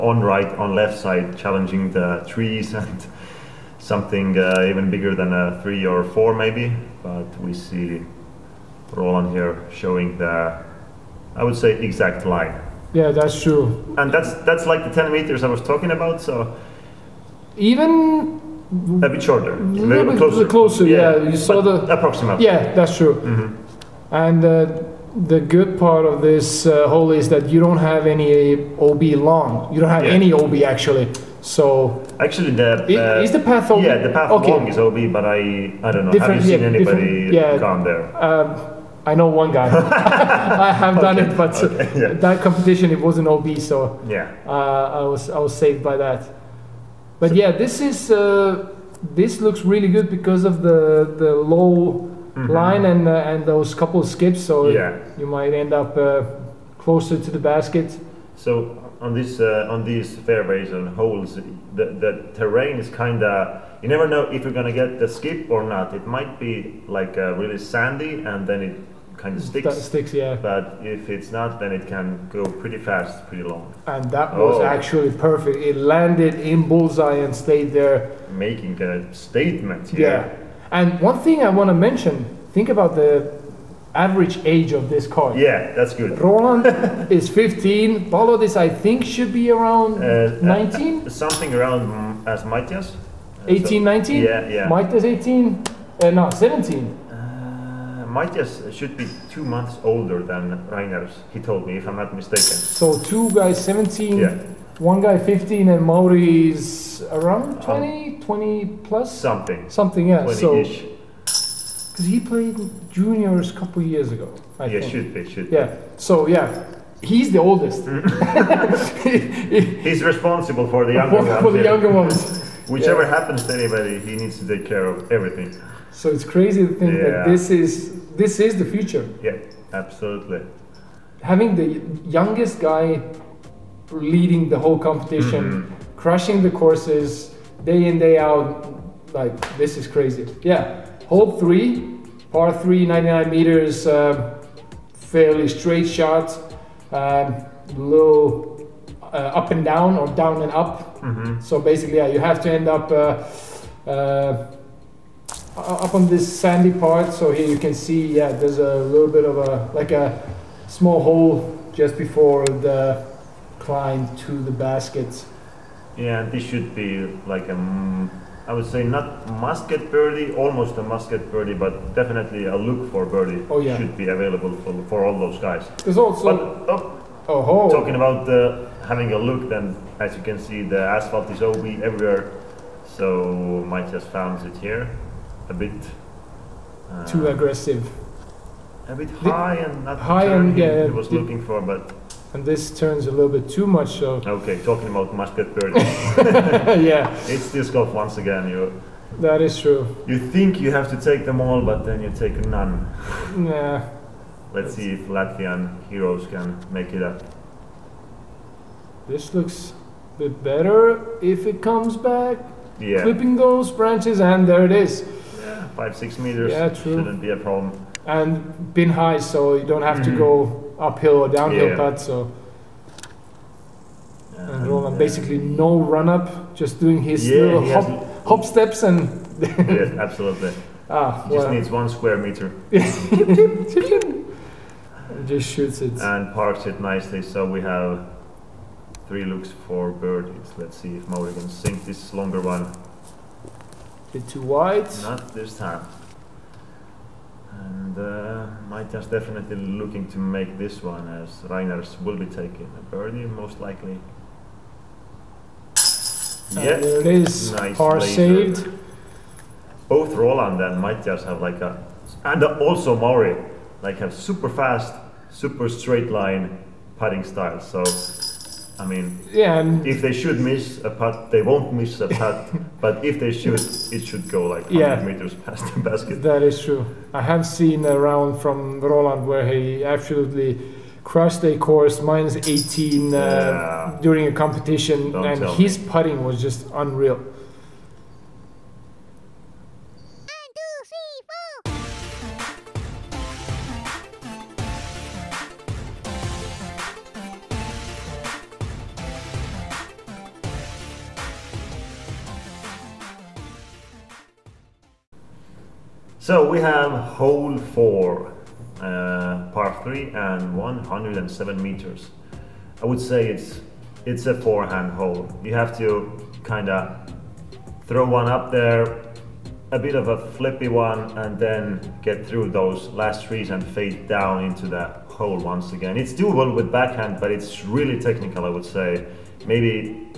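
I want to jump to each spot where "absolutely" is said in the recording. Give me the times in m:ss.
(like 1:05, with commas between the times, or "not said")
2:09, 3:50, 4:39.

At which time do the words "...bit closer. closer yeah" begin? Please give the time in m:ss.
0:20.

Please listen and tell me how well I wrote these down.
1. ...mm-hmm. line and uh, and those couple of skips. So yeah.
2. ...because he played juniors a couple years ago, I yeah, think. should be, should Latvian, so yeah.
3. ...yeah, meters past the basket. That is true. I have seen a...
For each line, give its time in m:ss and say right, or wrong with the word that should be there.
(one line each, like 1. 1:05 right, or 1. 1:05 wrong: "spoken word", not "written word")
1. 0:52 right
2. 1:51 wrong: "Yeah", not "Latvian"
3. 4:34 right.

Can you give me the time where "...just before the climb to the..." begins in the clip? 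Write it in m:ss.
2:41.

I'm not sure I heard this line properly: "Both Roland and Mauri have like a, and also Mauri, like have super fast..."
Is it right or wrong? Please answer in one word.
wrong.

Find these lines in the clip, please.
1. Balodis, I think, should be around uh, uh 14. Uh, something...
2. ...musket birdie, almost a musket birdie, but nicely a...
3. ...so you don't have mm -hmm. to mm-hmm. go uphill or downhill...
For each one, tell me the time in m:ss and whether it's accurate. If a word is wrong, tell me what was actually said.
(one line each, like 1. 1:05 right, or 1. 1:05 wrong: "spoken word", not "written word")
1. 1:28 wrong: "19", not "14"
2. 2:49 wrong: "definitely", not "nicely"
3. 3:39 right.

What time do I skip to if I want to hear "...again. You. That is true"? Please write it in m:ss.
3:18.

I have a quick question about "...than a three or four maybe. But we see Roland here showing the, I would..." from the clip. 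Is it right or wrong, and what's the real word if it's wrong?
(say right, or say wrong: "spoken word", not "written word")
right.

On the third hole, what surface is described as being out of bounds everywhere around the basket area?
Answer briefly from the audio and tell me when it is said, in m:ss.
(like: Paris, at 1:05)
Asphalt, at 3:00.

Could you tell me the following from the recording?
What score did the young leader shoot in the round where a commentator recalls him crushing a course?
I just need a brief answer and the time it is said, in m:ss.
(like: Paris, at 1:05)
Minus 18, at 4:42.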